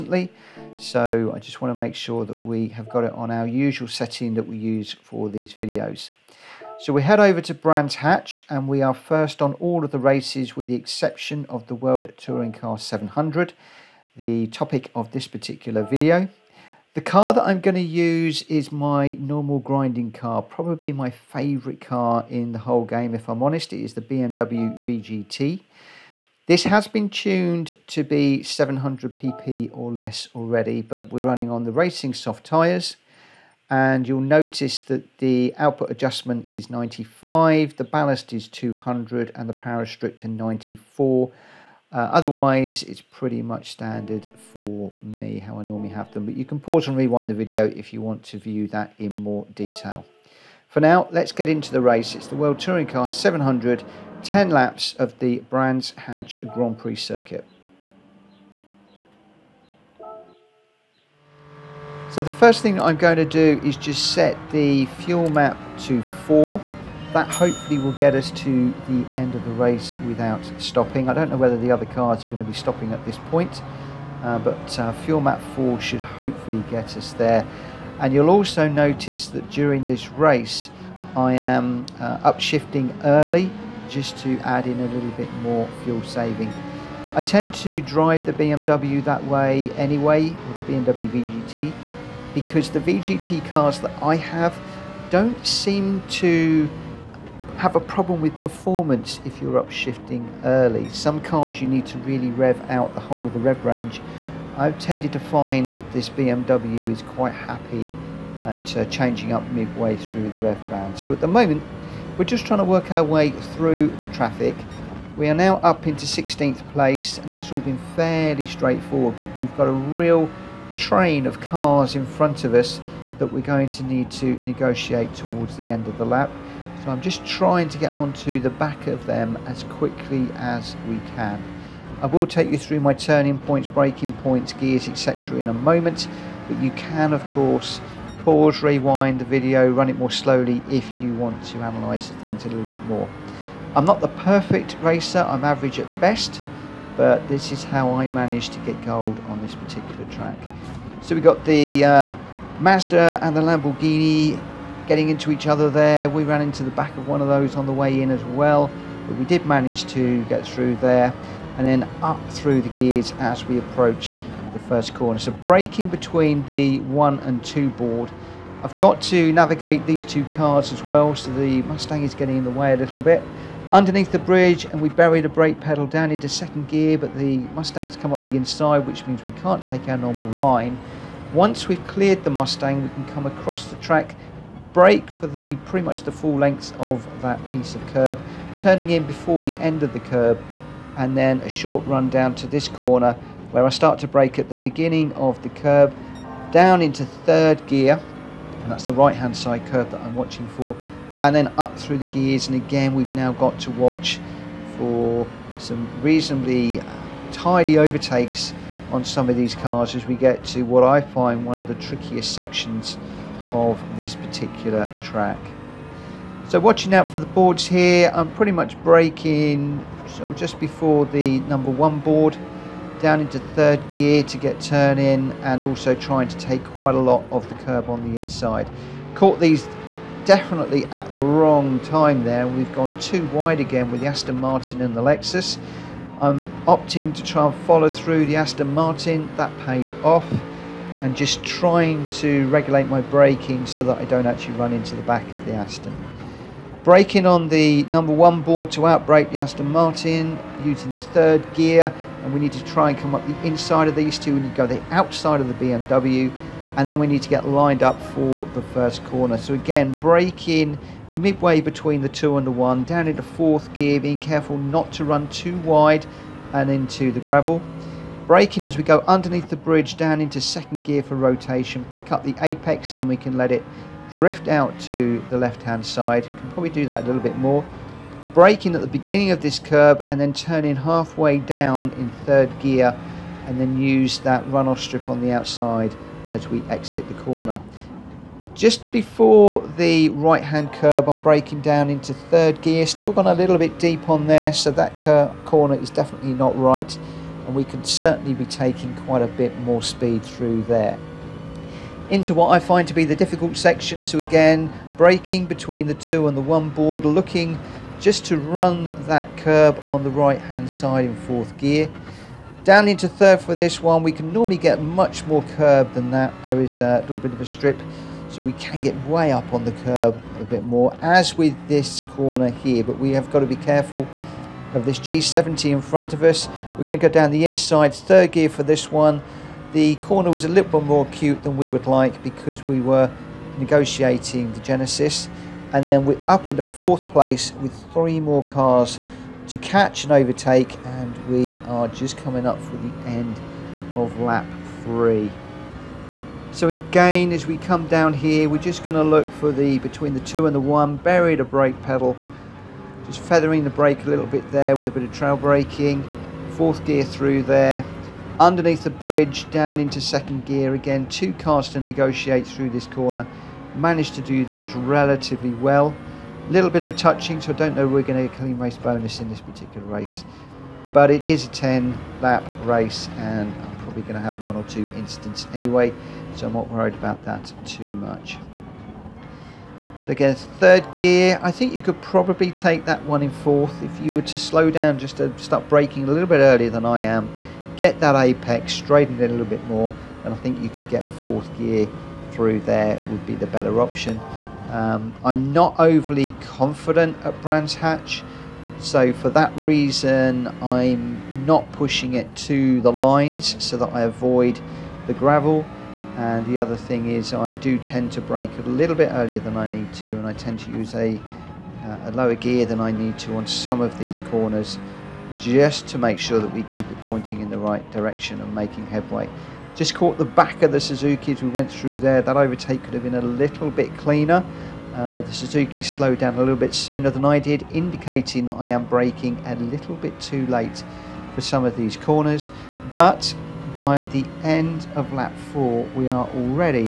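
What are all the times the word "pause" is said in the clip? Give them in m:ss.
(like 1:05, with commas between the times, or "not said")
0:46, 2:18.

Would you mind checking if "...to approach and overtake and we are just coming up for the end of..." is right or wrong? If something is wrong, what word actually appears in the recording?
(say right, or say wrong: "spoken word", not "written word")
wrong: "catch", not "approach".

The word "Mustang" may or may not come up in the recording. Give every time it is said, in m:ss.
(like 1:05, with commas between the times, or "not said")
2:51, 2:57, 3:02.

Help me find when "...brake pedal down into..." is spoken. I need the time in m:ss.
2:55.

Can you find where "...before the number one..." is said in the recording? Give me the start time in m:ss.
3:40.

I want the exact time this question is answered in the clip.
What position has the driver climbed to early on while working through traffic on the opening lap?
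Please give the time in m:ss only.
1:56.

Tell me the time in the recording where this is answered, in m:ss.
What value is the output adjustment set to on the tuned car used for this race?
0:36.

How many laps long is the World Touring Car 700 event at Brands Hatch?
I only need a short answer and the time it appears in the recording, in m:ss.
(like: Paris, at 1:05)
10, at 0:54.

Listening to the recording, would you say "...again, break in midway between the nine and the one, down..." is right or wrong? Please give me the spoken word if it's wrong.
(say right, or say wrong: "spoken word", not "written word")
wrong: "two", not "nine".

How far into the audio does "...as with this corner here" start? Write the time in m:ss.
5:21.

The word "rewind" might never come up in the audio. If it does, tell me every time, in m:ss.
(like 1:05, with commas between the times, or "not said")
0:46, 2:18.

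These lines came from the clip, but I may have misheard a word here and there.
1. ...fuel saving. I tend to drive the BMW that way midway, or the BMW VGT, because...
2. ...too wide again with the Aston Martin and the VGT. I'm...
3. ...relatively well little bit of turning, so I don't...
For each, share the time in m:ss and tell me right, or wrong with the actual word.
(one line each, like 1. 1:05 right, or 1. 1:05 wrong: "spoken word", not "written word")
1. 1:25 wrong: "anyway", not "midway"
2. 3:52 wrong: "Lexus", not "VGT"
3. 6:04 wrong: "touching", not "turning".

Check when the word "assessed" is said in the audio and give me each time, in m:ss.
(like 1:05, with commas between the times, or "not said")
not said.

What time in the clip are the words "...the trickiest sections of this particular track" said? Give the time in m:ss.
3:31.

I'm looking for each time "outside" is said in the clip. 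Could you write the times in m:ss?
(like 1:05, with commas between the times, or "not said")
4:14, 4:45.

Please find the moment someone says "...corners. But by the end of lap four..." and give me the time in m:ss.
7:11.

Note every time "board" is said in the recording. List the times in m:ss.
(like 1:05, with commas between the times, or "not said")
2:47, 3:37, 3:41, 4:08, 5:06.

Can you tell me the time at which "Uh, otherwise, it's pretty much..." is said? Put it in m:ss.
0:41.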